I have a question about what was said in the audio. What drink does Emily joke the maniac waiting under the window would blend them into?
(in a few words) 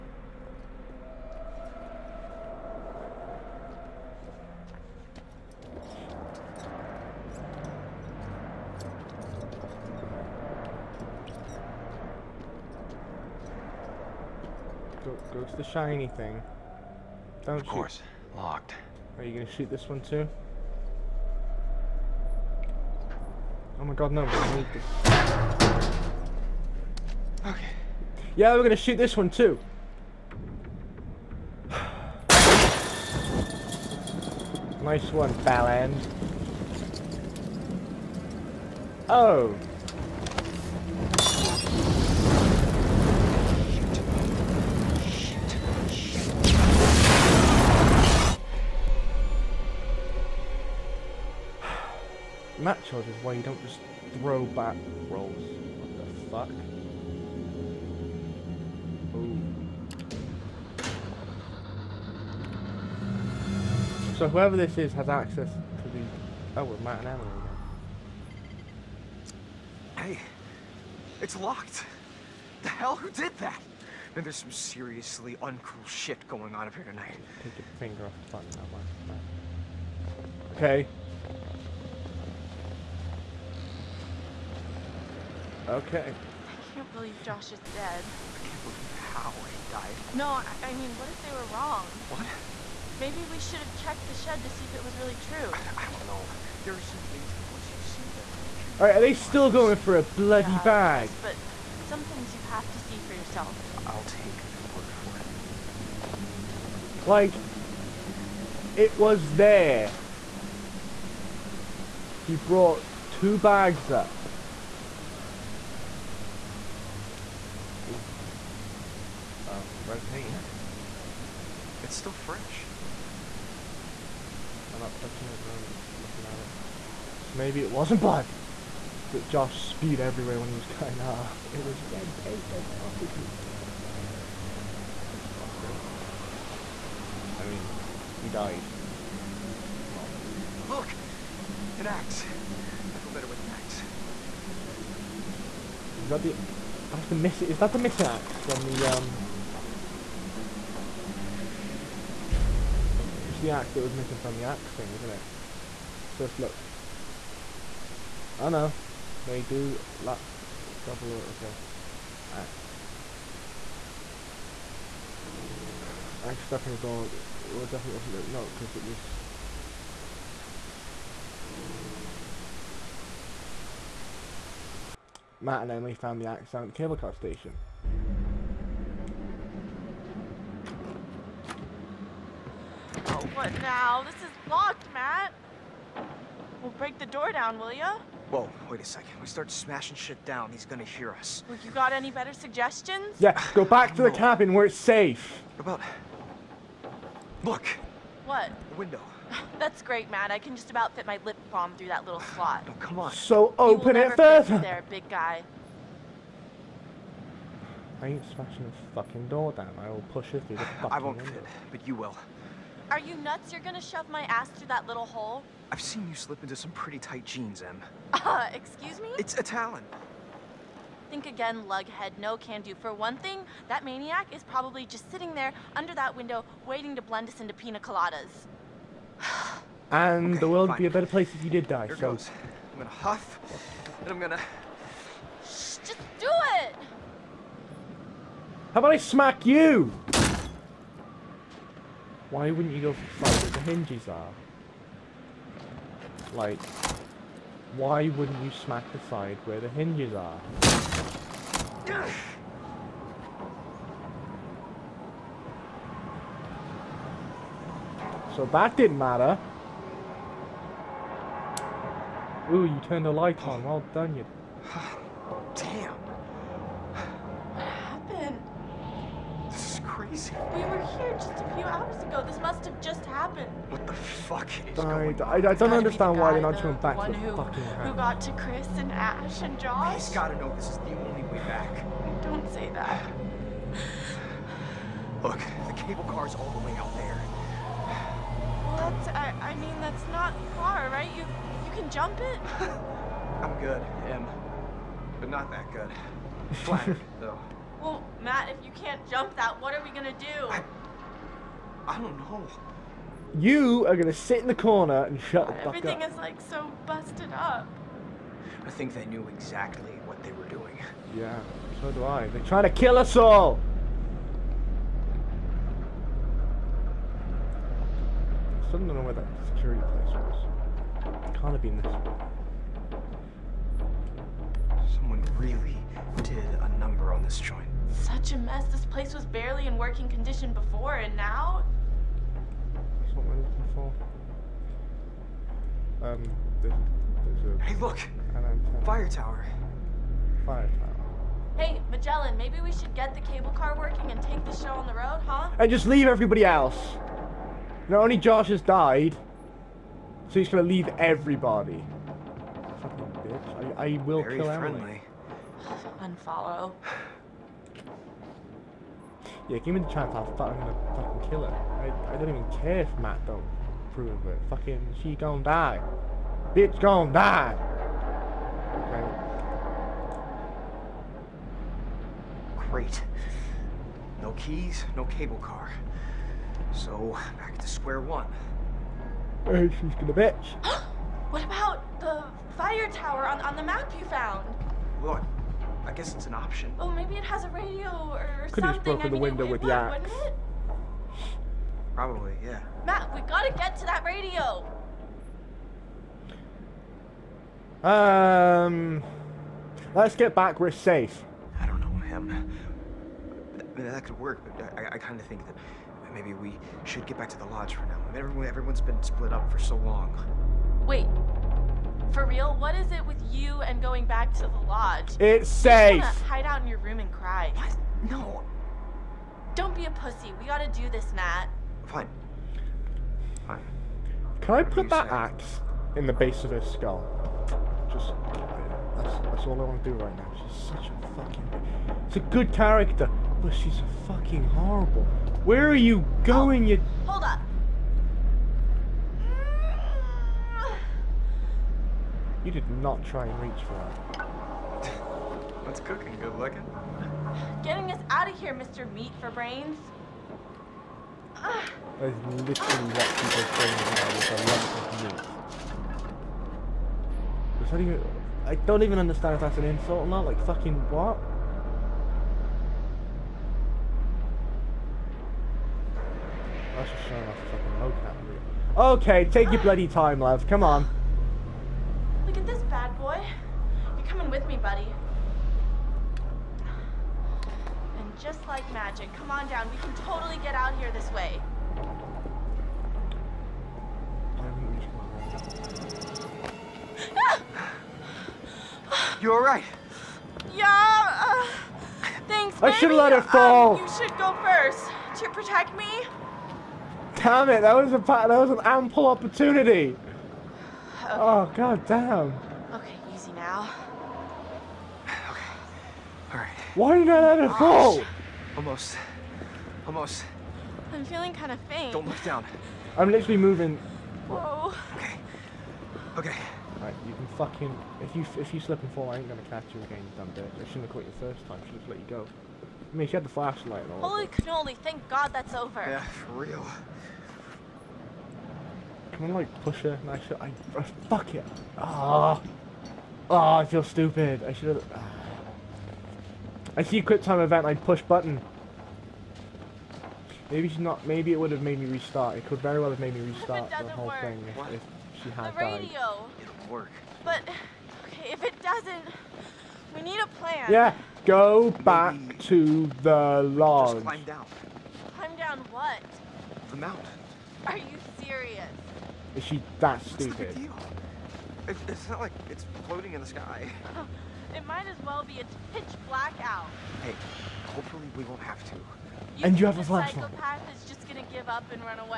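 pina coladas.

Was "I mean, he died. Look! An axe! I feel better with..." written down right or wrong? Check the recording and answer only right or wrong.
right.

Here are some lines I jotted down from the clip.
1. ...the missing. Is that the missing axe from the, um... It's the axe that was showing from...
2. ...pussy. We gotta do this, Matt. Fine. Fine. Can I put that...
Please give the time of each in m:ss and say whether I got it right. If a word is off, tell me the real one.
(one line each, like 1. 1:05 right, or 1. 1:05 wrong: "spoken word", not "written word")
1. 2:27 wrong: "missing", not "showing"
2. 6:59 right.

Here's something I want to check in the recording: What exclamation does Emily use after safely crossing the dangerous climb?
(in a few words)
Holy cannoli.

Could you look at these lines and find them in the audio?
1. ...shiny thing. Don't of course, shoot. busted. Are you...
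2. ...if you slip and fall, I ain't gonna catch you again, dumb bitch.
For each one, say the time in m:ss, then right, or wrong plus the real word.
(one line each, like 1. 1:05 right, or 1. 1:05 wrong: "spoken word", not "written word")
1. 0:15 wrong: "locked", not "busted"
2. 8:38 right.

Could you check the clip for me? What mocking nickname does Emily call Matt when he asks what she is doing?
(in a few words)
Mr. Meat for Brains.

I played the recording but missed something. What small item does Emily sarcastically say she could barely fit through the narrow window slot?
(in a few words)
lip balm.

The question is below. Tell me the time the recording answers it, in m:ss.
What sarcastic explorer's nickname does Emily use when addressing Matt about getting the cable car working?
5:41.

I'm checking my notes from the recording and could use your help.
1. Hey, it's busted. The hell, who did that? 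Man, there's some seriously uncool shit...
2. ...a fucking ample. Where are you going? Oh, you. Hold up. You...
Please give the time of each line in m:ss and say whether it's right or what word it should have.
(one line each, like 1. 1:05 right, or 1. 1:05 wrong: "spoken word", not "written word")
1. 1:10 wrong: "locked", not "busted"
2. 7:13 wrong: "horrible", not "ample".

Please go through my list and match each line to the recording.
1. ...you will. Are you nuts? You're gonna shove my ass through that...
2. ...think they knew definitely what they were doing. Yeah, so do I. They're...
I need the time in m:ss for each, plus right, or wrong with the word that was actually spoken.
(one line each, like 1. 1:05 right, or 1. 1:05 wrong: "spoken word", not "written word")
1. 3:31 right
2. 5:08 wrong: "exactly", not "definitely".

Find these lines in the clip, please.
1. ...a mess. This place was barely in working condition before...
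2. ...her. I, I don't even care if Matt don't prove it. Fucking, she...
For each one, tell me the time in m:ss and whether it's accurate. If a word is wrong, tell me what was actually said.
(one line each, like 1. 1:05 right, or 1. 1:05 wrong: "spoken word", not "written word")
1. 5:28 right
2. 6:01 right.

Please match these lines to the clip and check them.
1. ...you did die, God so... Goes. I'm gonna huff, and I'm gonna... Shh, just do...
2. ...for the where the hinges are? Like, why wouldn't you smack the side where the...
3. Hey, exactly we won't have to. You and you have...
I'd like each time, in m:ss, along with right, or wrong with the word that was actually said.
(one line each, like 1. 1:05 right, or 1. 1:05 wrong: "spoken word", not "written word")
1. 3:51 wrong: "Here", not "God"
2. 4:02 right
3. 9:27 wrong: "hopefully", not "exactly".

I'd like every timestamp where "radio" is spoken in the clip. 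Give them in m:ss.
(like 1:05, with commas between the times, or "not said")
6:27, 6:34, 9:05.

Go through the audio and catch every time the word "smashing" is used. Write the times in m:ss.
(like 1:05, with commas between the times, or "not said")
3:09, 3:28.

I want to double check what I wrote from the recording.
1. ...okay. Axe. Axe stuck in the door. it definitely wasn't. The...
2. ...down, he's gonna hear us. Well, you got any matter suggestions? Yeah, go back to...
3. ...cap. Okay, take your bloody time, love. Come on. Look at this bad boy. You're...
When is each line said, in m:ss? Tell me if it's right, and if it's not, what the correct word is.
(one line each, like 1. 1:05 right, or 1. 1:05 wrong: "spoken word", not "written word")
1. 2:41 right
2. 3:10 wrong: "better", not "matter"
3. 7:48 right.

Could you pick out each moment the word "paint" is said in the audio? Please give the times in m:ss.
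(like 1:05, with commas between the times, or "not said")
2:00, 2:12.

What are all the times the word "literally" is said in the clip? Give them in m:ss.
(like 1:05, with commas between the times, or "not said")
7:31, 8:33.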